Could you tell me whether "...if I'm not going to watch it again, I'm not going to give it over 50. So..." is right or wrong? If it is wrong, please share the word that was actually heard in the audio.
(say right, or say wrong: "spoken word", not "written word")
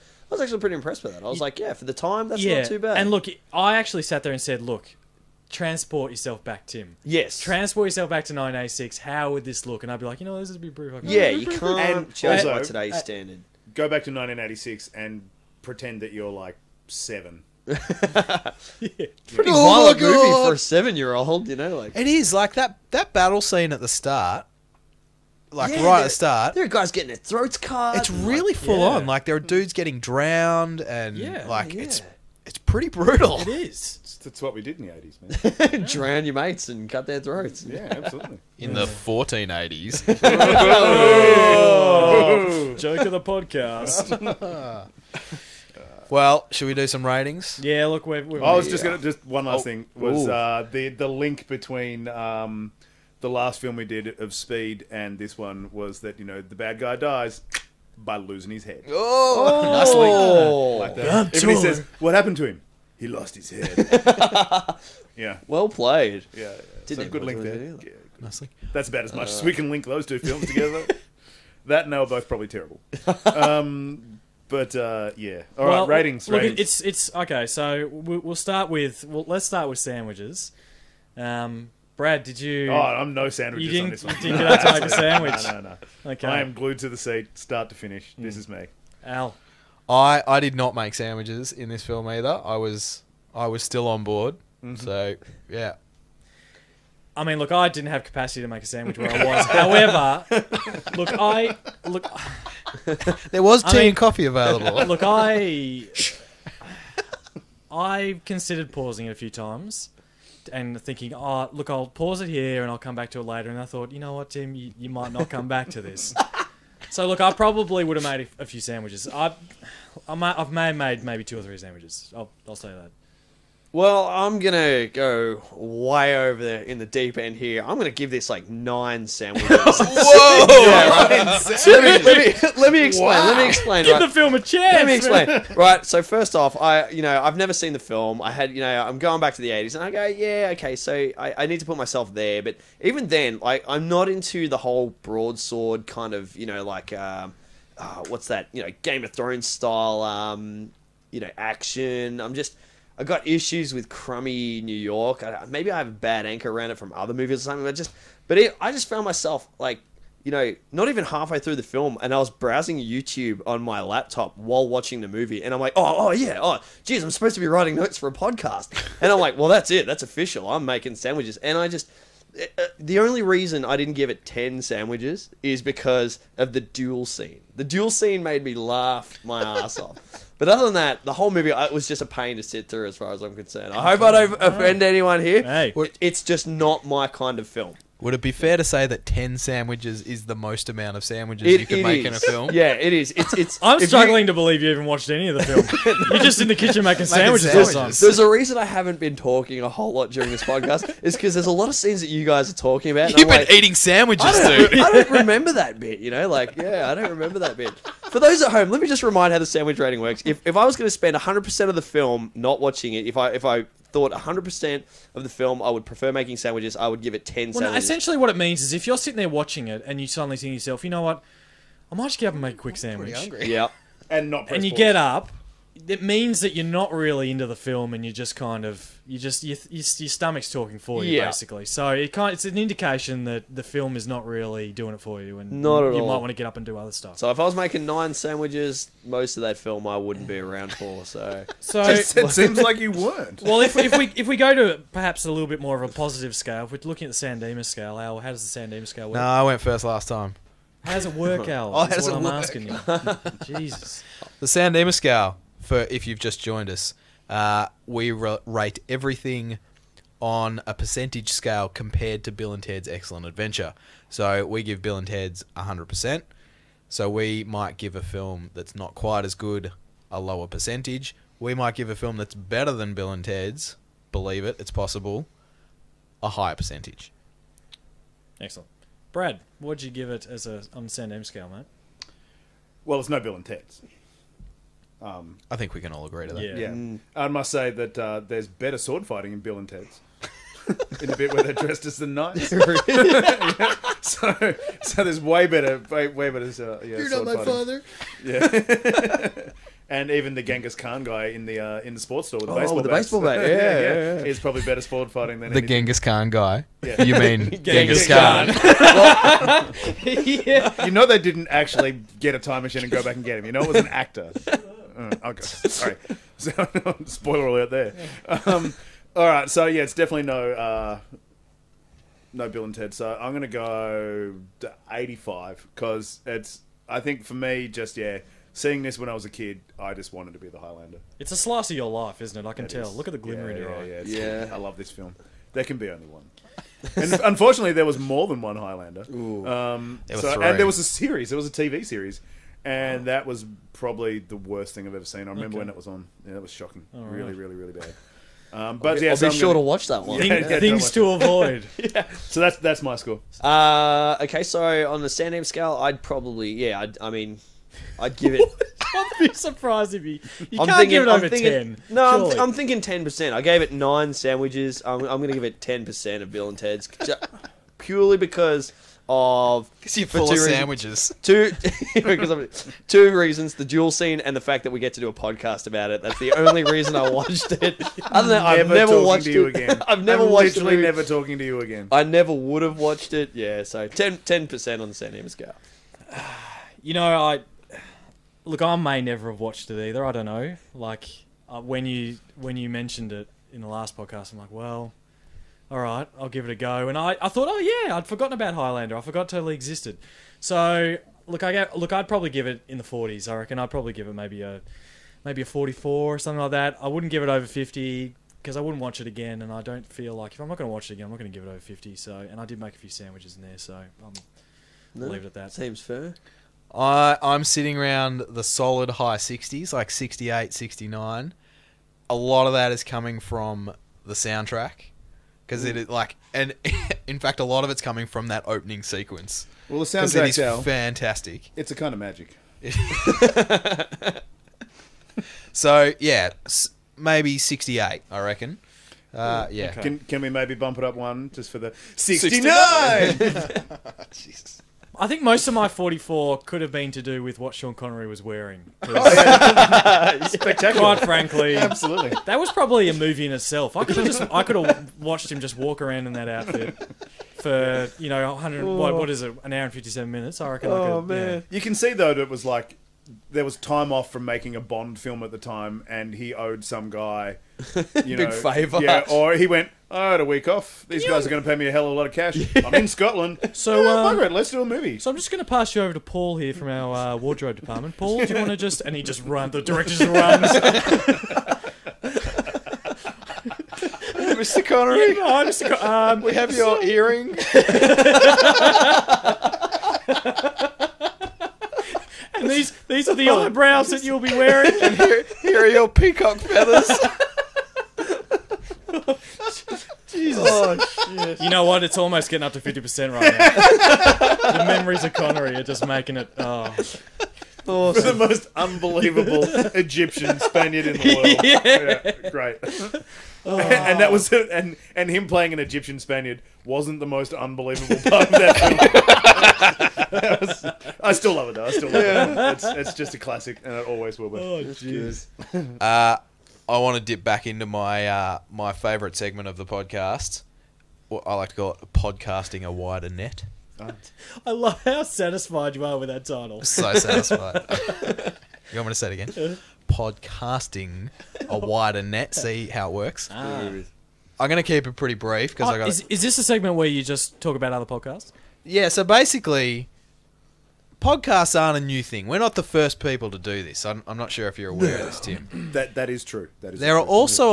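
right.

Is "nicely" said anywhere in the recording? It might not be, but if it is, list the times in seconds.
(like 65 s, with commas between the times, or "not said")
60 s, 68 s.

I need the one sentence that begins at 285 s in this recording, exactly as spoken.
Um, I think we can all agree to that.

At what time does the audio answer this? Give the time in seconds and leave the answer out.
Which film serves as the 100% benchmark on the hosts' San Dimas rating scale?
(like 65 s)
262 s.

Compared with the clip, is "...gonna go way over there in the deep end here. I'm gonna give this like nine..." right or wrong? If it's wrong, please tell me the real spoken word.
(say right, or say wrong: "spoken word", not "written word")
right.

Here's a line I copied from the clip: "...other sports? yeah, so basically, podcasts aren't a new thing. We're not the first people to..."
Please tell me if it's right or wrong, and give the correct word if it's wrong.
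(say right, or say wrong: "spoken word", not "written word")
wrong: "podcasts", not "sports".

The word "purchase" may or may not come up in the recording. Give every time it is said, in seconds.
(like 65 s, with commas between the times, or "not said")
not said.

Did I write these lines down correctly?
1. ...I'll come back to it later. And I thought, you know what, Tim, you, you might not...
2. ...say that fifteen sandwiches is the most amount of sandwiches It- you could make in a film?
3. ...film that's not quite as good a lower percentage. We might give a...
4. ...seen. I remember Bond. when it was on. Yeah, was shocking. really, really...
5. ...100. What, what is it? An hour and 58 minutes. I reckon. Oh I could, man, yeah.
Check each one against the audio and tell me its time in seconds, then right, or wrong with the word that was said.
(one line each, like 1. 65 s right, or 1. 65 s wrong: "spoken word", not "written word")
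1. 112 s right
2. 188 s wrong: "ten", not "fifteen"
3. 268 s right
4. 345 s wrong: "Okay", not "Bond"
5. 458 s wrong: "57", not "58".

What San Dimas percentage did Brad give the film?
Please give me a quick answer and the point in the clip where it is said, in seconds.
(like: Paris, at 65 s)
85, at 324 s.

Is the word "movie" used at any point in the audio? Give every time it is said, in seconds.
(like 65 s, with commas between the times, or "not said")
20 s, 157 s, 165 s, 181 s, 452 s, 474 s.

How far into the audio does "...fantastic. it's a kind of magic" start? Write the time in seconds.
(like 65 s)
430 s.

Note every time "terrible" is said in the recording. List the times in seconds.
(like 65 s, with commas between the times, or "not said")
72 s.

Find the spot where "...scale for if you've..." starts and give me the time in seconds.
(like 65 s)
254 s.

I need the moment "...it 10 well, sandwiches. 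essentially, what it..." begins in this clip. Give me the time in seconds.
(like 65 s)
217 s.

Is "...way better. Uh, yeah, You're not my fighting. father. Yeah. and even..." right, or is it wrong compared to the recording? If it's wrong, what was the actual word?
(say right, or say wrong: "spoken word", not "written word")
right.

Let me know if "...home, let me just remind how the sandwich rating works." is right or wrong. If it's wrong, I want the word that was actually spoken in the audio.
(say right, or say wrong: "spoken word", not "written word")
right.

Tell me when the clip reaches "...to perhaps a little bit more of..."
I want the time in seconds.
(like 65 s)
244 s.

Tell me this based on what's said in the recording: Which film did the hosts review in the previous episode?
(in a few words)
Speed.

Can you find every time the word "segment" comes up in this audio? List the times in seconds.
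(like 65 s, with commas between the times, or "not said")
529 s, 546 s.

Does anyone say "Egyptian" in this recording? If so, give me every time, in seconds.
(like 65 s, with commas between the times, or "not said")
509 s, 515 s.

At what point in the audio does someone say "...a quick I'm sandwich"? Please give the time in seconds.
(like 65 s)
222 s.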